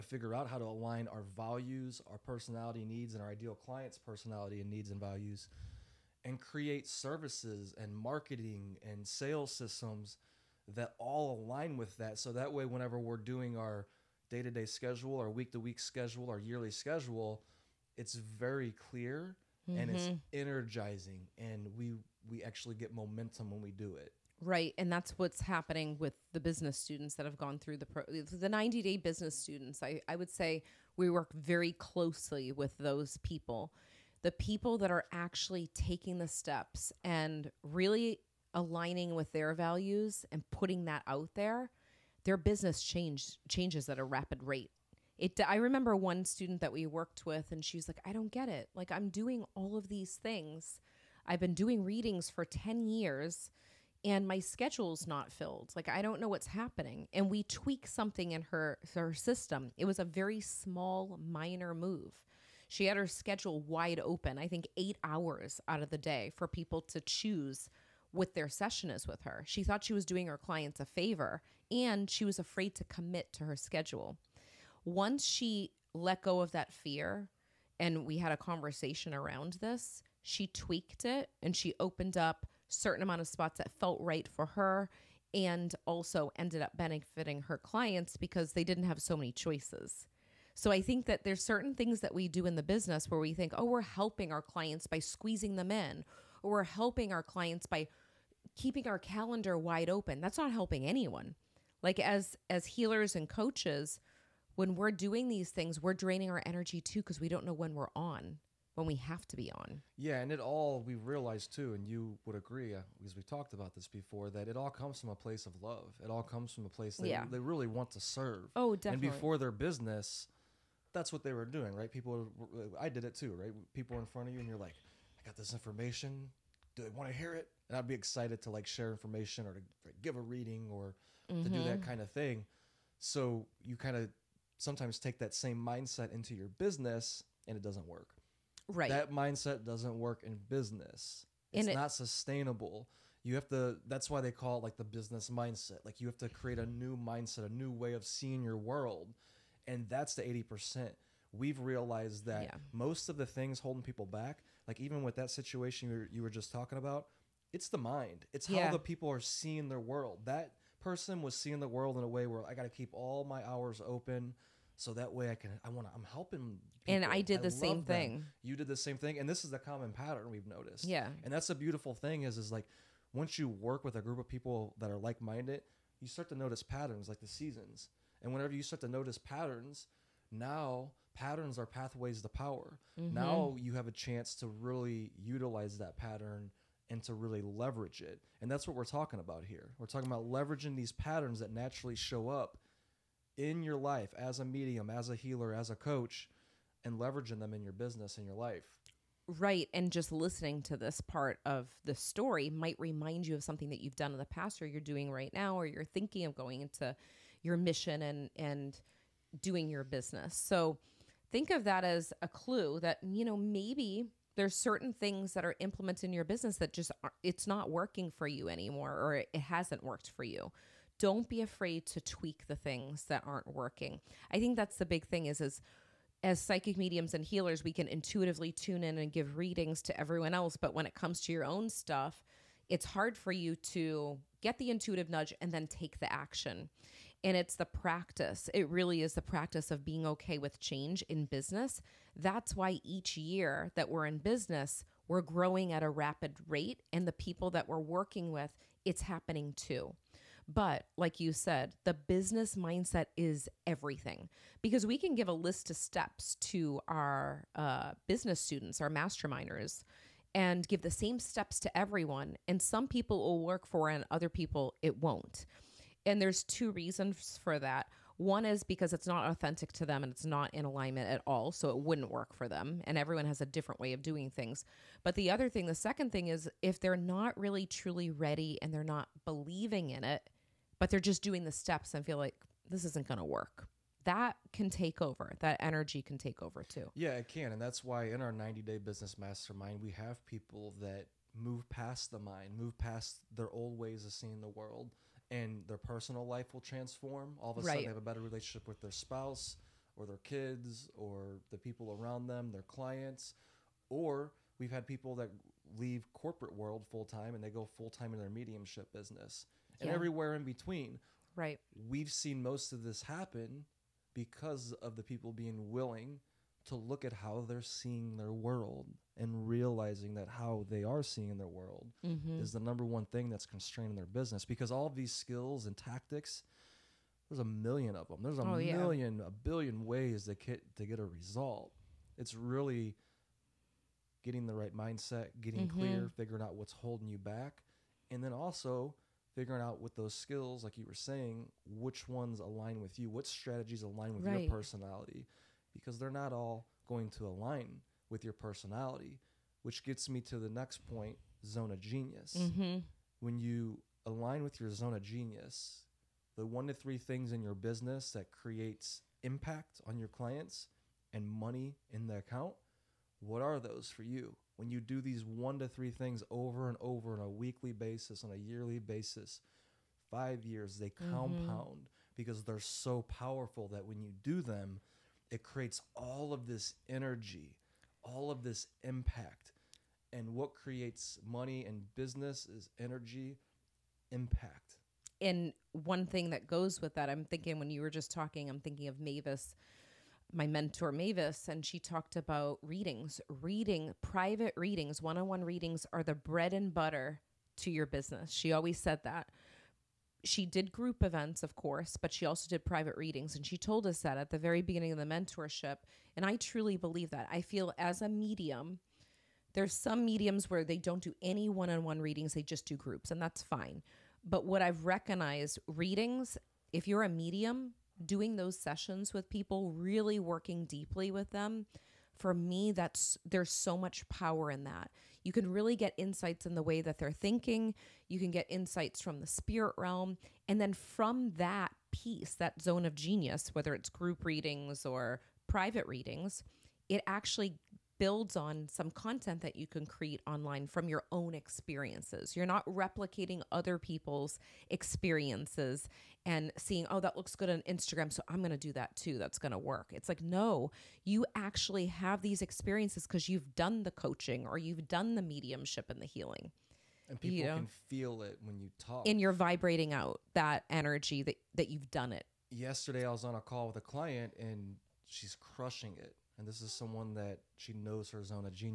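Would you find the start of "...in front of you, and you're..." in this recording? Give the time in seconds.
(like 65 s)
123 s.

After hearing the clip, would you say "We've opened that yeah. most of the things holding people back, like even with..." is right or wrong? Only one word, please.
wrong.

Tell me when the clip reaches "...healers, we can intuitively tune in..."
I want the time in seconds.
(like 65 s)
227 s.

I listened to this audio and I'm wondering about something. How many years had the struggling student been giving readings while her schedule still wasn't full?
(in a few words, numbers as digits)
10.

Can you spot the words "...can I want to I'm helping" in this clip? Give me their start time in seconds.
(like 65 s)
165 s.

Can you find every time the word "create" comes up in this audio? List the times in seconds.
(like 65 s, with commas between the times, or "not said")
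6 s, 146 s, 358 s, 375 s, 380 s, 439 s.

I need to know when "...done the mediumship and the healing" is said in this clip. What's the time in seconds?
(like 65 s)
454 s.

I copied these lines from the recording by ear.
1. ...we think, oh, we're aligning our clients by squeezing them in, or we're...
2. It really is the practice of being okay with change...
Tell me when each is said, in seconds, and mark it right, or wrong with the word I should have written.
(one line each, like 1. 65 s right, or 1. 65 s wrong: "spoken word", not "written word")
1. 93 s wrong: "helping", not "aligning"
2. 238 s right.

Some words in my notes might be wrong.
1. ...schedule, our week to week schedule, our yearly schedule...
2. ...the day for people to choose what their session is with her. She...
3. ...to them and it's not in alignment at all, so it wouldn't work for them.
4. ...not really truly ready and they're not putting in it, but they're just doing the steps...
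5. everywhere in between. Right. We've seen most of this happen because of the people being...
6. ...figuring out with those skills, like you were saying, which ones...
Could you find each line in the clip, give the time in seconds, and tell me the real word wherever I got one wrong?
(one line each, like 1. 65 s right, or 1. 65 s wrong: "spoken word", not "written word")
1. 14 s right
2. 65 s right
3. 269 s right
4. 276 s wrong: "believing", not "putting"
5. 309 s right
6. 339 s right.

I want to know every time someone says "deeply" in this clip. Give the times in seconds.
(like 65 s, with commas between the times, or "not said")
420 s.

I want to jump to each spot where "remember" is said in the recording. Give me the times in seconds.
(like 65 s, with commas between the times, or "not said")
45 s.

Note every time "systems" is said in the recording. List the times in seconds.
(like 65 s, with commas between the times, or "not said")
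9 s, 59 s.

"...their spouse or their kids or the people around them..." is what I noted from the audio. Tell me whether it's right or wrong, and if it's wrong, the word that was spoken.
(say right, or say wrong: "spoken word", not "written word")
right.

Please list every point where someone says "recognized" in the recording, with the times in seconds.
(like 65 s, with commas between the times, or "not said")
414 s.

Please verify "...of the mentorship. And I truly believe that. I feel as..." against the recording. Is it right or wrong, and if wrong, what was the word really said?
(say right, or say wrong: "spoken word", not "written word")
right.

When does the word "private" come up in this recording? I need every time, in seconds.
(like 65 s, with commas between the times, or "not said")
394 s, 402 s, 435 s.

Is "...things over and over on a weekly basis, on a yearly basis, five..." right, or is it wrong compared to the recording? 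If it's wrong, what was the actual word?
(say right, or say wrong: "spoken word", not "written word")
right.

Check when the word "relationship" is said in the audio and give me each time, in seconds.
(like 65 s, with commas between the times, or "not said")
298 s.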